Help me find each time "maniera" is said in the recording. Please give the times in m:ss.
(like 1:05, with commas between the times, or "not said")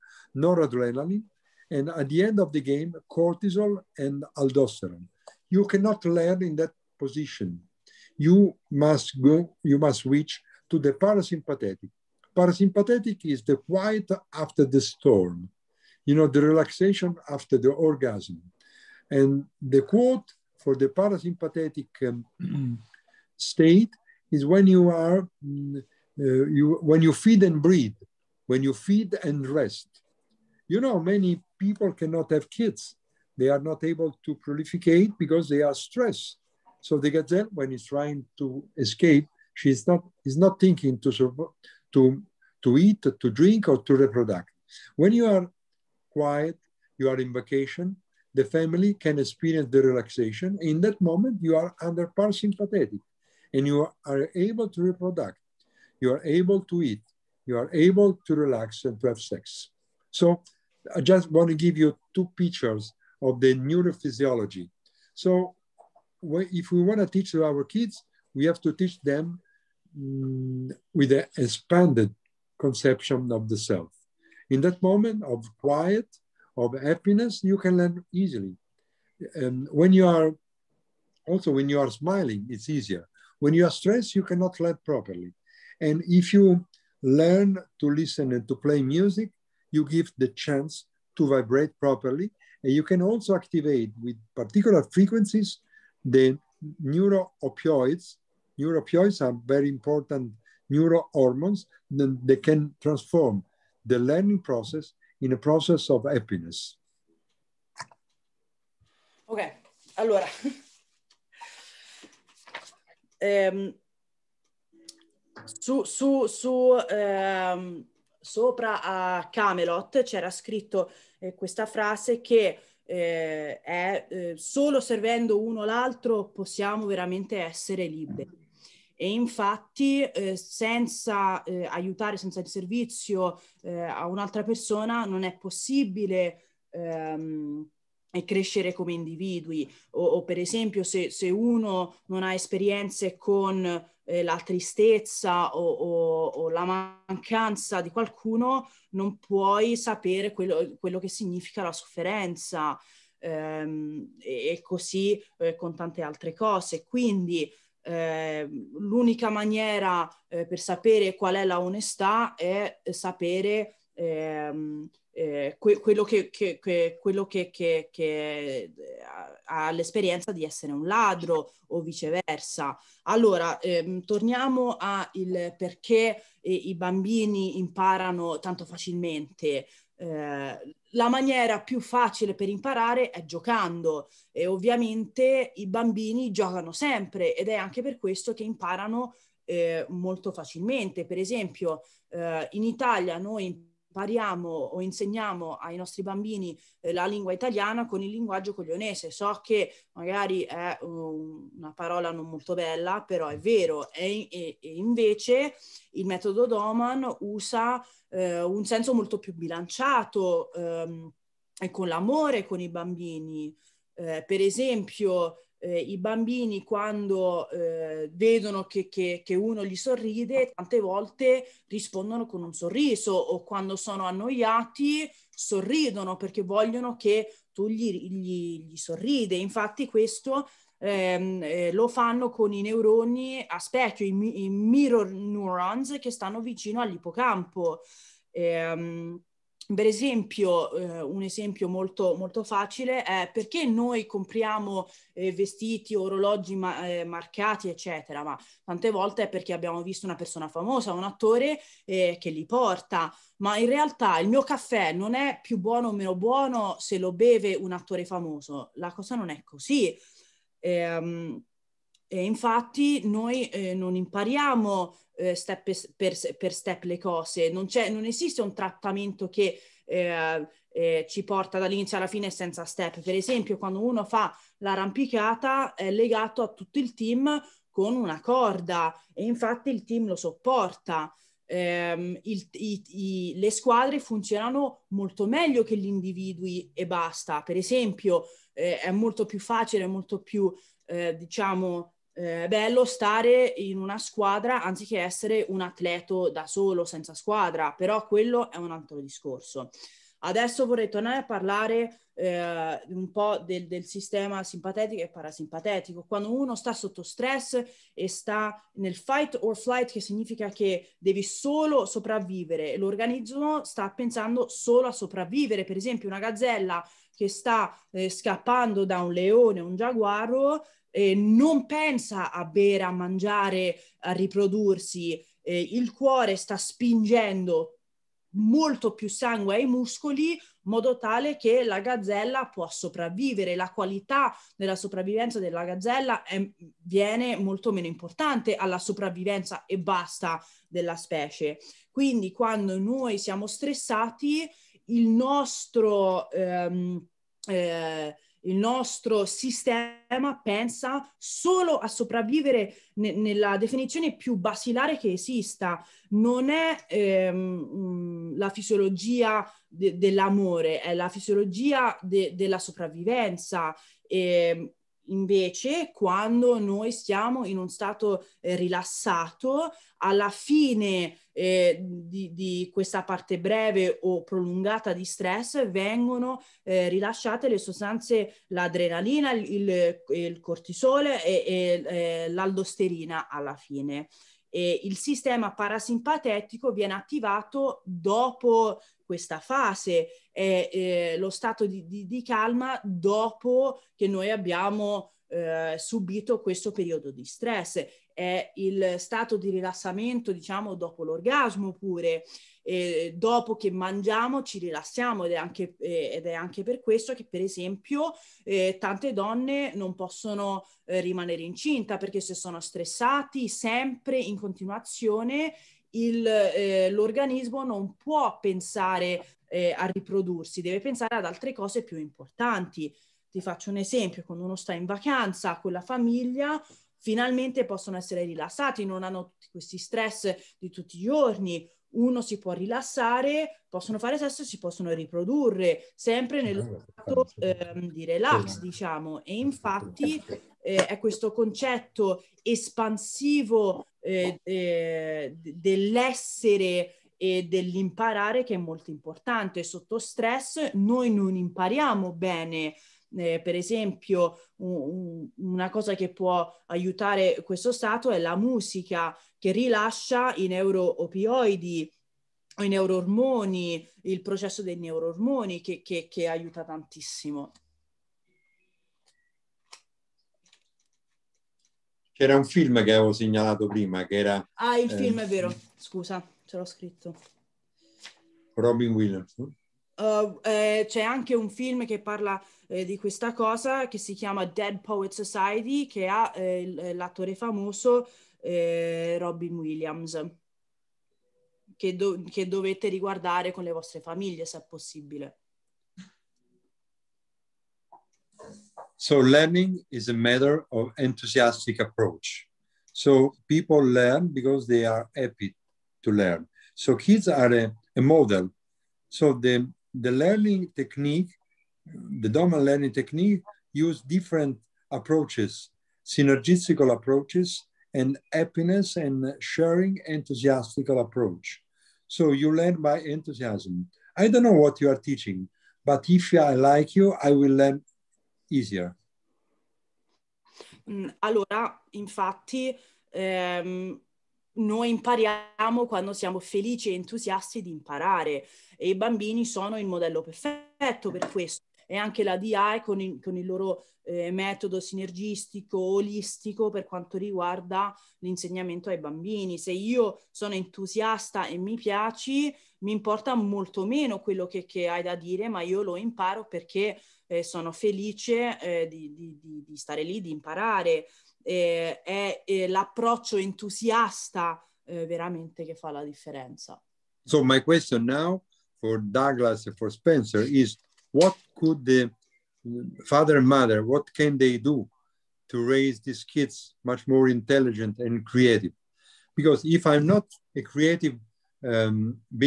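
2:39, 3:01.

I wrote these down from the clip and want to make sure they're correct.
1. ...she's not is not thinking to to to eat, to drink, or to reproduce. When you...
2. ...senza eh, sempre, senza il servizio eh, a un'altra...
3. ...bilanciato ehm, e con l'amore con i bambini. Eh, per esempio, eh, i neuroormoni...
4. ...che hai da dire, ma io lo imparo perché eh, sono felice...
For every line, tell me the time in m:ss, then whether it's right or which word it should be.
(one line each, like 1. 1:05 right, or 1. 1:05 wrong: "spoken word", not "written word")
1. 0:39 right
2. 2:10 wrong: "aiutare", not "sempre"
3. 3:29 wrong: "bambini", not "neuroormoni"
4. 9:14 right.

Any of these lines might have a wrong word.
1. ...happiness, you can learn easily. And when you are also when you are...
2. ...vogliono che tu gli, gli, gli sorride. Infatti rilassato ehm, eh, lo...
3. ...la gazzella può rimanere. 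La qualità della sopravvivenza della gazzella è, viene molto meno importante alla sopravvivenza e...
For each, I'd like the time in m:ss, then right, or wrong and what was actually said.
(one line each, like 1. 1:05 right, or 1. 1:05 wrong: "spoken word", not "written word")
1. 1:16 right
2. 3:46 wrong: "questo", not "rilassato"
3. 5:31 wrong: "sopravvivere", not "rimanere".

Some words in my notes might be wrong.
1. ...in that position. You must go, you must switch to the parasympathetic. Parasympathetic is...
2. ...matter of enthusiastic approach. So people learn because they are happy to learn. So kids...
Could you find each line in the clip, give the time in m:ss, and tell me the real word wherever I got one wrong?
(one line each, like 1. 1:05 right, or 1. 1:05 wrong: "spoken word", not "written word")
1. 0:06 right
2. 8:20 right.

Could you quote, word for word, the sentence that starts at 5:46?
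Ehm, eh, il nostro sistema pensa solo a sopravvivere ne- nella definizione più basilare che esista.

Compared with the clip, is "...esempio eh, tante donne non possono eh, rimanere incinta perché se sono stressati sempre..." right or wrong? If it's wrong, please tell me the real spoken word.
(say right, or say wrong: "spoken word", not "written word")
right.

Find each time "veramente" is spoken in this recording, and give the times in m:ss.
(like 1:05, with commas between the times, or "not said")
2:06, 9:25.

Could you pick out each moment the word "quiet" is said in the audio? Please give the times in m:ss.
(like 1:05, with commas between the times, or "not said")
0:13, 0:46, 1:15.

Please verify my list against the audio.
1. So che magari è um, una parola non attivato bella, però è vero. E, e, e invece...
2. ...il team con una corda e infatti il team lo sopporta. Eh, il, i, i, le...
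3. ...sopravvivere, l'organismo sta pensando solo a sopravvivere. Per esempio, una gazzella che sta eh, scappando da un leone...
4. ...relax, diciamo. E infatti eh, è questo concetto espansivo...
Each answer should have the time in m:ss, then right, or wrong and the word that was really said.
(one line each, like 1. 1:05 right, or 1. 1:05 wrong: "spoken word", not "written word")
1. 3:19 wrong: "molto", not "attivato"
2. 4:36 right
3. 5:11 right
4. 7:18 right.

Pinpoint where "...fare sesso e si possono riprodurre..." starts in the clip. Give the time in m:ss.
7:13.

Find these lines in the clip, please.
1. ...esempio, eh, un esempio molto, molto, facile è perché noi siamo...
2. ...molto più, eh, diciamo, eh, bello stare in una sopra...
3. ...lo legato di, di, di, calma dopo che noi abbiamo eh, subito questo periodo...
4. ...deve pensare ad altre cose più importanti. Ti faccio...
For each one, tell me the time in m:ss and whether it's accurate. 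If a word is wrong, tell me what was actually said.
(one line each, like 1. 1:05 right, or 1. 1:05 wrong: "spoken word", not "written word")
1. 3:59 wrong: "compriamo", not "siamo"
2. 4:49 wrong: "squadra", not "sopra"
3. 6:31 wrong: "stato", not "legato"
4. 7:00 right.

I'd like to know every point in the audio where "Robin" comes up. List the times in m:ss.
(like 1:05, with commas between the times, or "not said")
7:58, 8:09.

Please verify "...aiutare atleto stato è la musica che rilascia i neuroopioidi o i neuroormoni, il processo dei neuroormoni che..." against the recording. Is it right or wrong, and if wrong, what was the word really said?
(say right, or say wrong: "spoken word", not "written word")
wrong: "questo", not "atleto".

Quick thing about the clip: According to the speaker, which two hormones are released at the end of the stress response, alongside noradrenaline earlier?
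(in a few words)
cortisol and aldosterone.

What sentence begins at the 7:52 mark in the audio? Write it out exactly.
C'era un film che avevo segnalato prima, che era...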